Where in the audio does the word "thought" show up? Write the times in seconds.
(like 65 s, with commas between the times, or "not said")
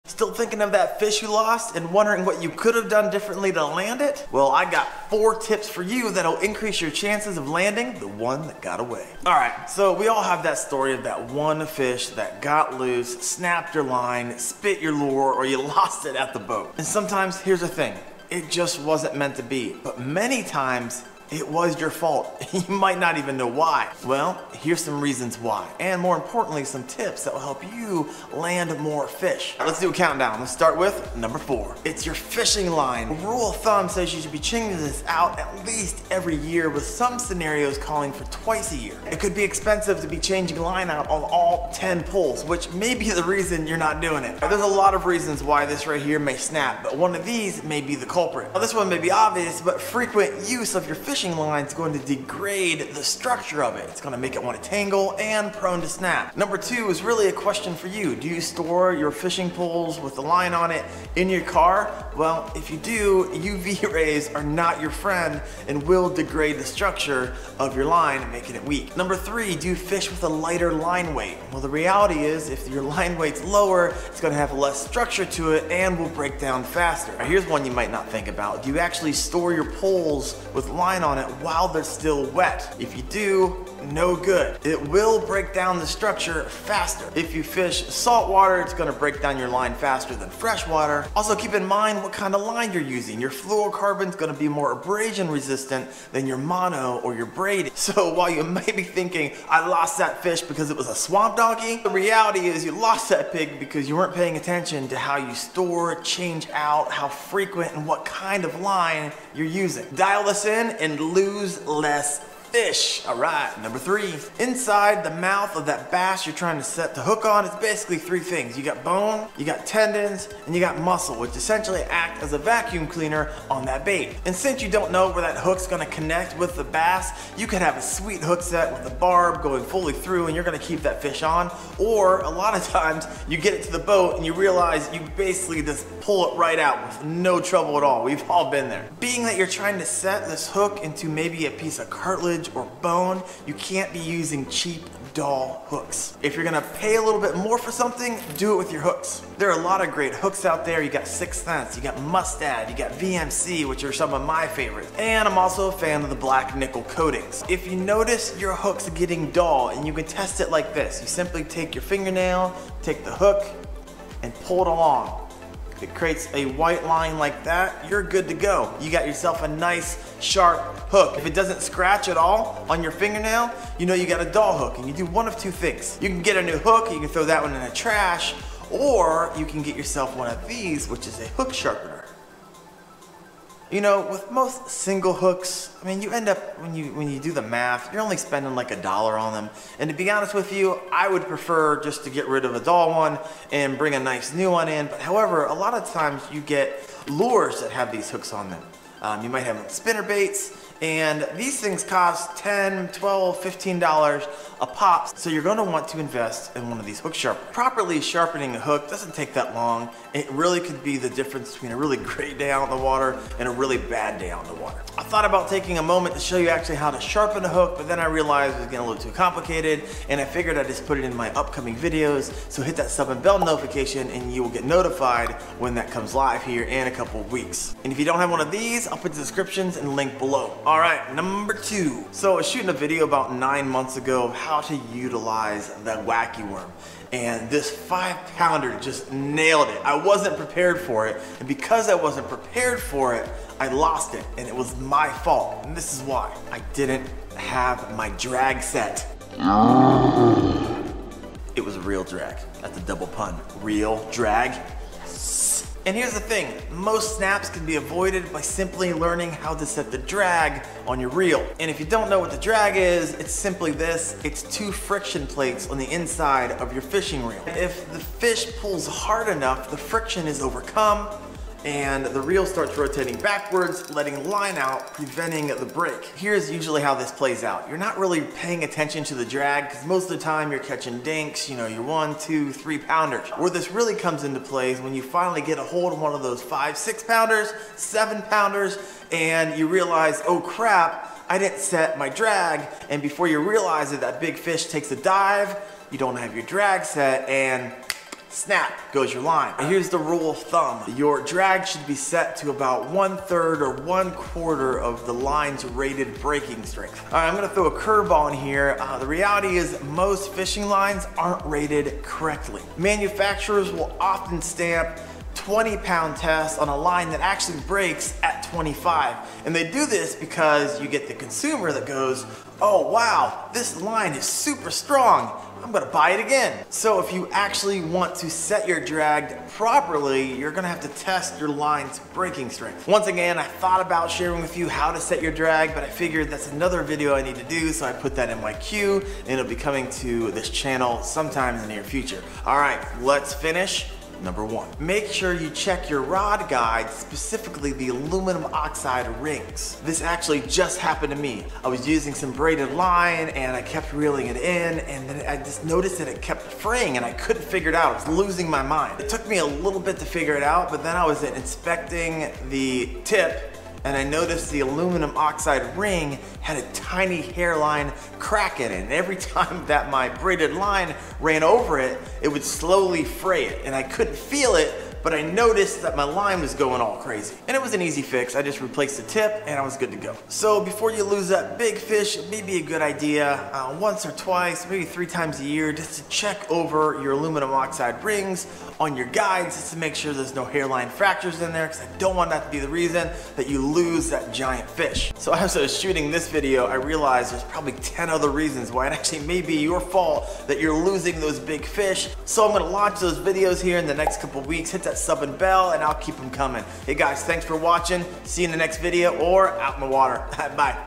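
215 s, 333 s.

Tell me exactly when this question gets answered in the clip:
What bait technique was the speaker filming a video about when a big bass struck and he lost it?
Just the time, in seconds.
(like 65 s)
236 s.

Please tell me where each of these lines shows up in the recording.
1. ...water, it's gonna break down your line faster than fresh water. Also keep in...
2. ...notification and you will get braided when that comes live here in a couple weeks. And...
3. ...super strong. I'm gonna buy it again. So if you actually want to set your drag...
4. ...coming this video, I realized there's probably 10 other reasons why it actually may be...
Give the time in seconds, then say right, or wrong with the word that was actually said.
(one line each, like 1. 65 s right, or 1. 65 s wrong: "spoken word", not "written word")
1. 88 s right
2. 223 s wrong: "notified", not "braided"
3. 324 s right
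4. 395 s wrong: "shooting", not "coming".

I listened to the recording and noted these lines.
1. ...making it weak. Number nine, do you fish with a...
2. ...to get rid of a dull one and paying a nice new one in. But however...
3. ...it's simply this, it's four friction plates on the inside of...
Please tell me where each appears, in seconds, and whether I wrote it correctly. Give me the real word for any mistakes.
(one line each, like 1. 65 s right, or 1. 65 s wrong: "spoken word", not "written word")
1. 68 s wrong: "three", not "nine"
2. 192 s wrong: "bring", not "paying"
3. 263 s wrong: "two", not "four".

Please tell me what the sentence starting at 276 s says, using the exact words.
Here's usually how this plays out.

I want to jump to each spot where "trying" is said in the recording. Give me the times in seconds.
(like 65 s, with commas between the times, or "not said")
116 s, 139 s.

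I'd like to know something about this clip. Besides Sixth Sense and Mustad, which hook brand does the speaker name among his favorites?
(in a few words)
VMC.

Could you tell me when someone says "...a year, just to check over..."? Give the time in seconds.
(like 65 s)
385 s.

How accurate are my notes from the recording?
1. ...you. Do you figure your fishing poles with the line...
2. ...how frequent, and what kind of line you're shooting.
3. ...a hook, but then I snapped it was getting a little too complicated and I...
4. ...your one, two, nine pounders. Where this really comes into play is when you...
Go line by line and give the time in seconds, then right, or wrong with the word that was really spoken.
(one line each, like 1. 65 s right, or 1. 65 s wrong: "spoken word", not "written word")
1. 57 s wrong: "store", not "figure"
2. 106 s wrong: "using", not "shooting"
3. 217 s wrong: "realized", not "snapped"
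4. 281 s wrong: "three", not "nine".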